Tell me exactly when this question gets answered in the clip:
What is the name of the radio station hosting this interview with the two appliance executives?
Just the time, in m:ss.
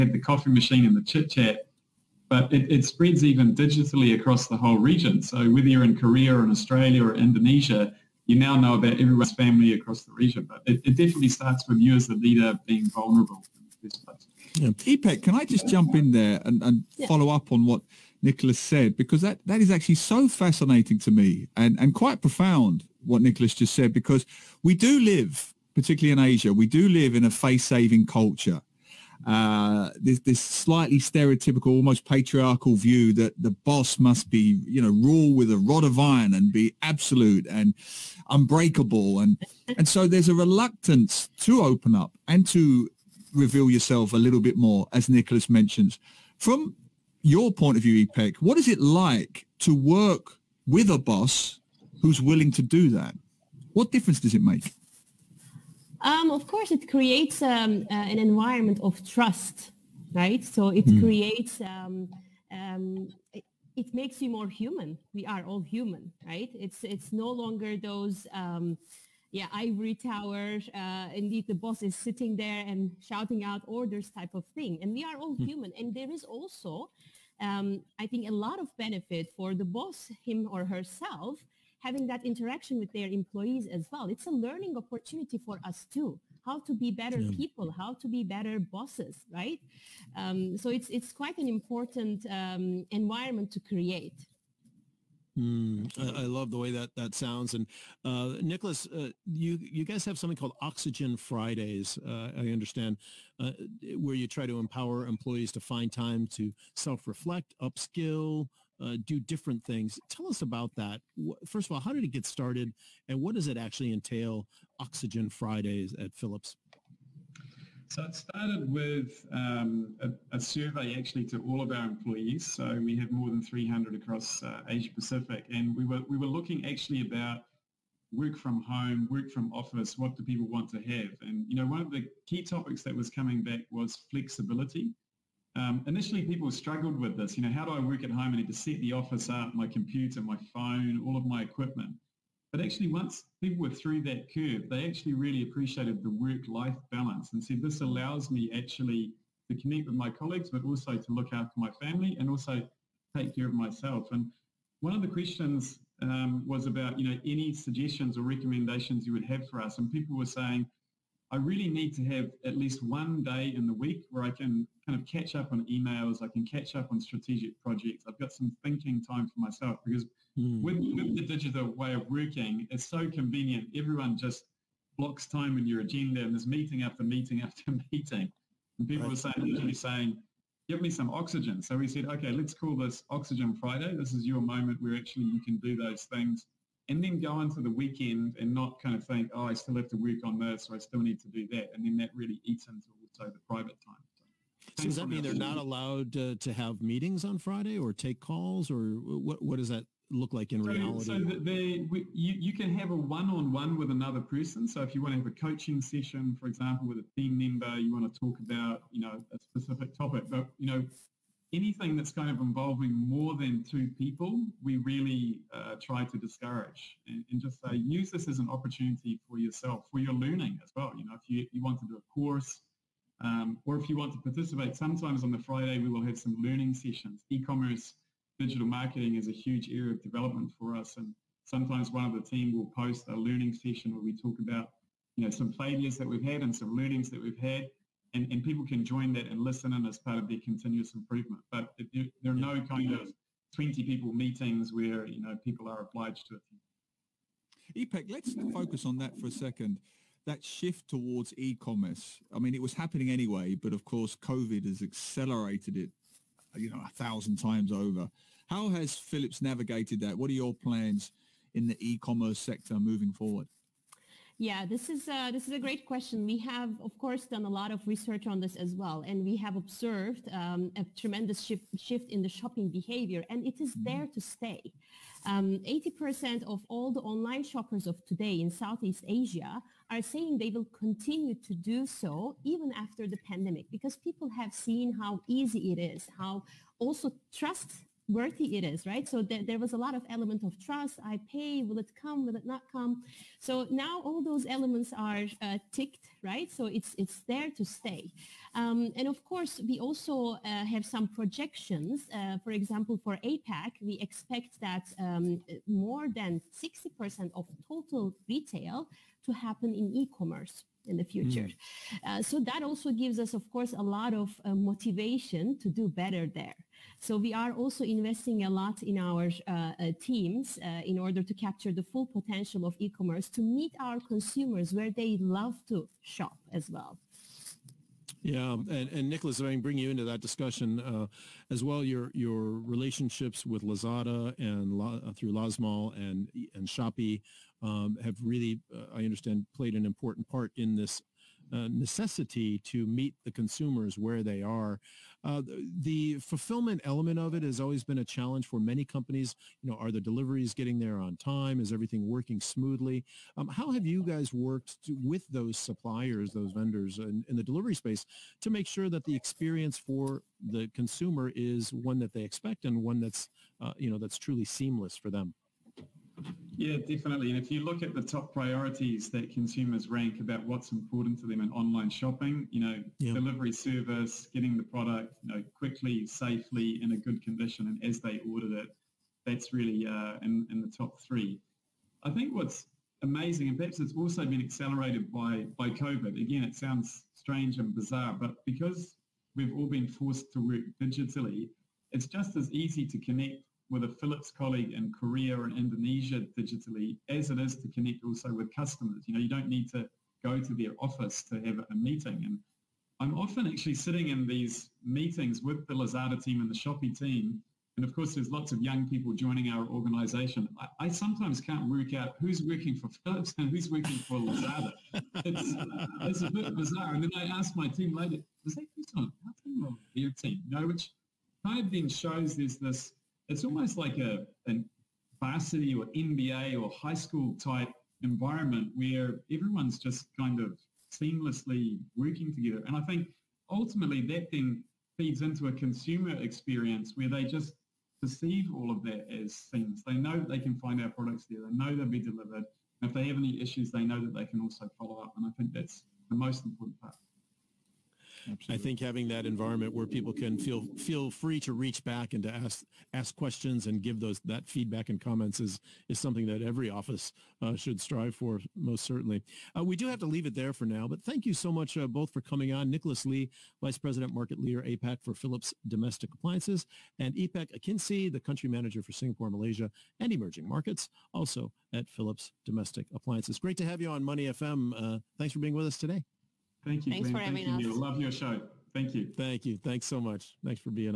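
7:54.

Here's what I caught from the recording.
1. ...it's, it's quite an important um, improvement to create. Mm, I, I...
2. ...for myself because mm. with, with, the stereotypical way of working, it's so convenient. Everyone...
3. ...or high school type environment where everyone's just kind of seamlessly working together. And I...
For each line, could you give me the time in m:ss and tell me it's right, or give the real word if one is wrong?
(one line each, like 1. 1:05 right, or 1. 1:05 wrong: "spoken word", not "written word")
1. 1:30 wrong: "environment", not "improvement"
2. 2:49 wrong: "digital", not "stereotypical"
3. 7:06 right.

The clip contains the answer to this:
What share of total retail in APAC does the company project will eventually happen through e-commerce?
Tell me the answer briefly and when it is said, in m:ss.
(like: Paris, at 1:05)
more than 60%, at 5:05.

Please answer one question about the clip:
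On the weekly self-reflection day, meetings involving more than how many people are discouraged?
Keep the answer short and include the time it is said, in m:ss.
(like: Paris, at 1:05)
2, at 3:33.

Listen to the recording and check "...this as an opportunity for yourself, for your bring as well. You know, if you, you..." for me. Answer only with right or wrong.
wrong.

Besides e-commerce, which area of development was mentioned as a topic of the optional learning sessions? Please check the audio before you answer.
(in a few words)
digital marketing.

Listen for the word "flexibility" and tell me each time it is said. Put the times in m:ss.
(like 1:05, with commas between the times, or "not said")
2:14.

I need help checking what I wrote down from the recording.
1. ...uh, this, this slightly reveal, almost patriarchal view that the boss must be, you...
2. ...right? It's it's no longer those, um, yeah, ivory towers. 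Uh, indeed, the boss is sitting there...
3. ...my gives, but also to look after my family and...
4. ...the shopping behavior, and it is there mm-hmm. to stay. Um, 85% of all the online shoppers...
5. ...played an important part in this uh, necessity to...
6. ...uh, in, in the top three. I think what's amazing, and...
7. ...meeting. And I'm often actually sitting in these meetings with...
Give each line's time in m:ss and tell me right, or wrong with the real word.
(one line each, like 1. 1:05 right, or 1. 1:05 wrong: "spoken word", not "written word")
1. 0:29 wrong: "stereotypical", not "reveal"
2. 1:06 right
3. 2:29 wrong: "colleagues", not "gives"
4. 4:32 wrong: "80", not "85"
5. 5:39 right
6. 6:19 right
7. 6:41 right.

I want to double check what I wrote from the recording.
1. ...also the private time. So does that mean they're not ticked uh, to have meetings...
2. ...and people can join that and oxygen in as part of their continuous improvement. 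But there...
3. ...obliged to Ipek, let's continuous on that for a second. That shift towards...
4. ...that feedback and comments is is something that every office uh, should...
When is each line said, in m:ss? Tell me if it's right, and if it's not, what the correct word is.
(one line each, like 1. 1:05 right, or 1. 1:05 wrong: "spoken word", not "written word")
1. 3:13 wrong: "allowed", not "ticked"
2. 3:58 wrong: "listen", not "oxygen"
3. 4:05 wrong: "focus", not "continuous"
4. 7:34 right.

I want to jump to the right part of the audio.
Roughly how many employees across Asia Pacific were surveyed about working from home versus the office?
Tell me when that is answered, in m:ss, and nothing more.
2:03.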